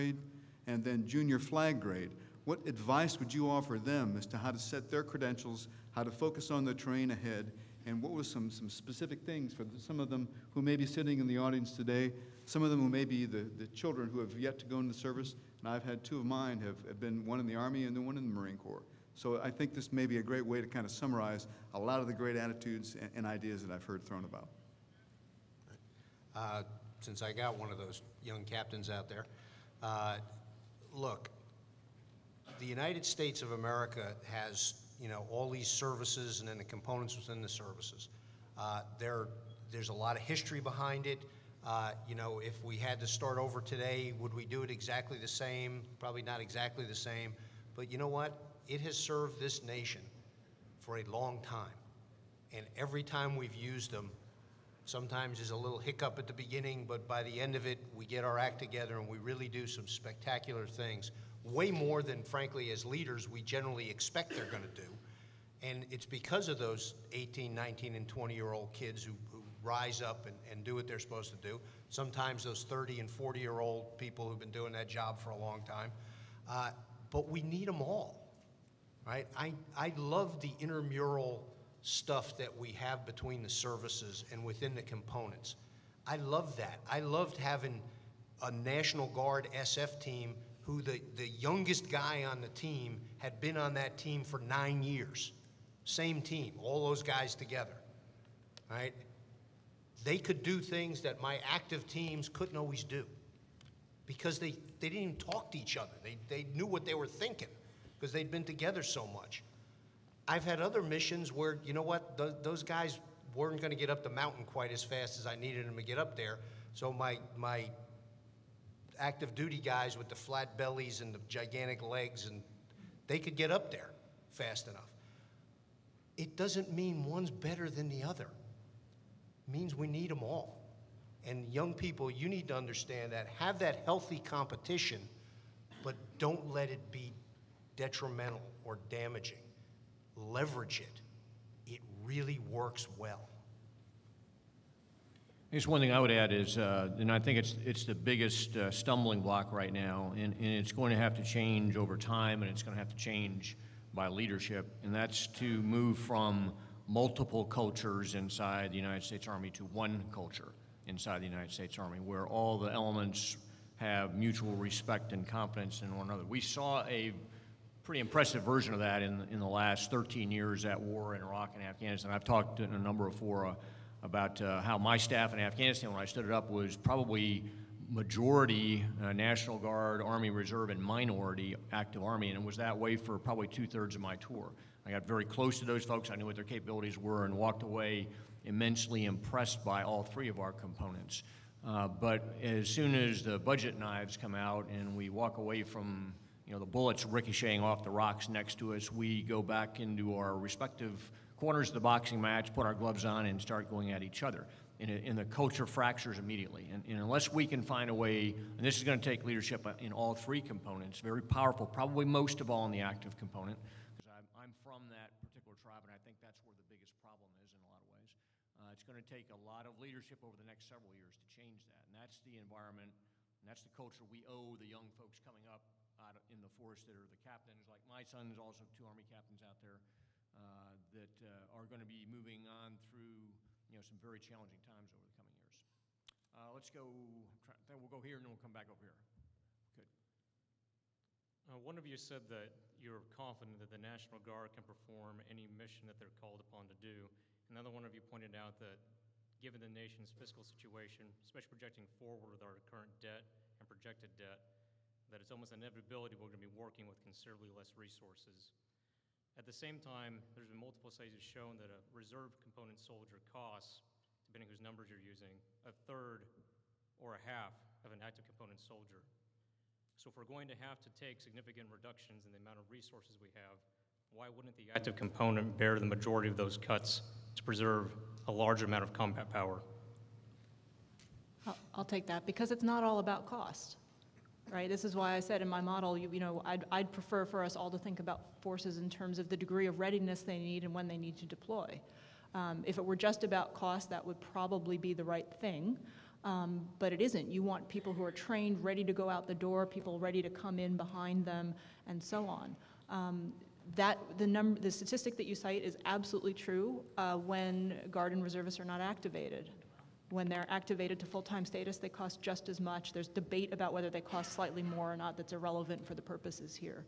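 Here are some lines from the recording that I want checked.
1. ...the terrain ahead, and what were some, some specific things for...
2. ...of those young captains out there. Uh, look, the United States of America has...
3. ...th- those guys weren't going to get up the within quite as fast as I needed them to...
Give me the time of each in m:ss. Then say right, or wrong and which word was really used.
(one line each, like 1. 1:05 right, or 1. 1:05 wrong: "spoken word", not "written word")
1. 0:06 right
2. 0:27 right
3. 1:52 wrong: "mountain", not "within".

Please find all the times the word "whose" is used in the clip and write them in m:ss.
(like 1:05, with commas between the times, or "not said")
4:24.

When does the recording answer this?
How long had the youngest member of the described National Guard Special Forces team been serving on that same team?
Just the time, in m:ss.
1:34.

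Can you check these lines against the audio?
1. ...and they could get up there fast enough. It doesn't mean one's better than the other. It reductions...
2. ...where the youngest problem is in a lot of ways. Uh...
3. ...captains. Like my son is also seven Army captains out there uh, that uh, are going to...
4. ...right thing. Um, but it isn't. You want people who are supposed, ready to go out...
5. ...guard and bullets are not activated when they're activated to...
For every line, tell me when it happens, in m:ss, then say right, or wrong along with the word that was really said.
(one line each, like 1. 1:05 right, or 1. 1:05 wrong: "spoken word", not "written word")
1. 2:02 wrong: "means", not "reductions"
2. 3:36 wrong: "biggest", not "youngest"
3. 3:47 wrong: "two", not "seven"
4. 4:55 wrong: "trained", not "supposed"
5. 5:07 wrong: "reservists", not "bullets".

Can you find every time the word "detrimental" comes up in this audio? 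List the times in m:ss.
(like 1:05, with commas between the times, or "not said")
2:17.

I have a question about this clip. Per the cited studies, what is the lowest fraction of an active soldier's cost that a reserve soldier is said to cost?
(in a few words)
a third.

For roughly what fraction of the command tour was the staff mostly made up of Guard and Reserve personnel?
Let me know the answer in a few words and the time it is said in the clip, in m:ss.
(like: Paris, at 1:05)
two thirds, at 3:03.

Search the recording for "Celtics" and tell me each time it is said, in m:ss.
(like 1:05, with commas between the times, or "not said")
not said.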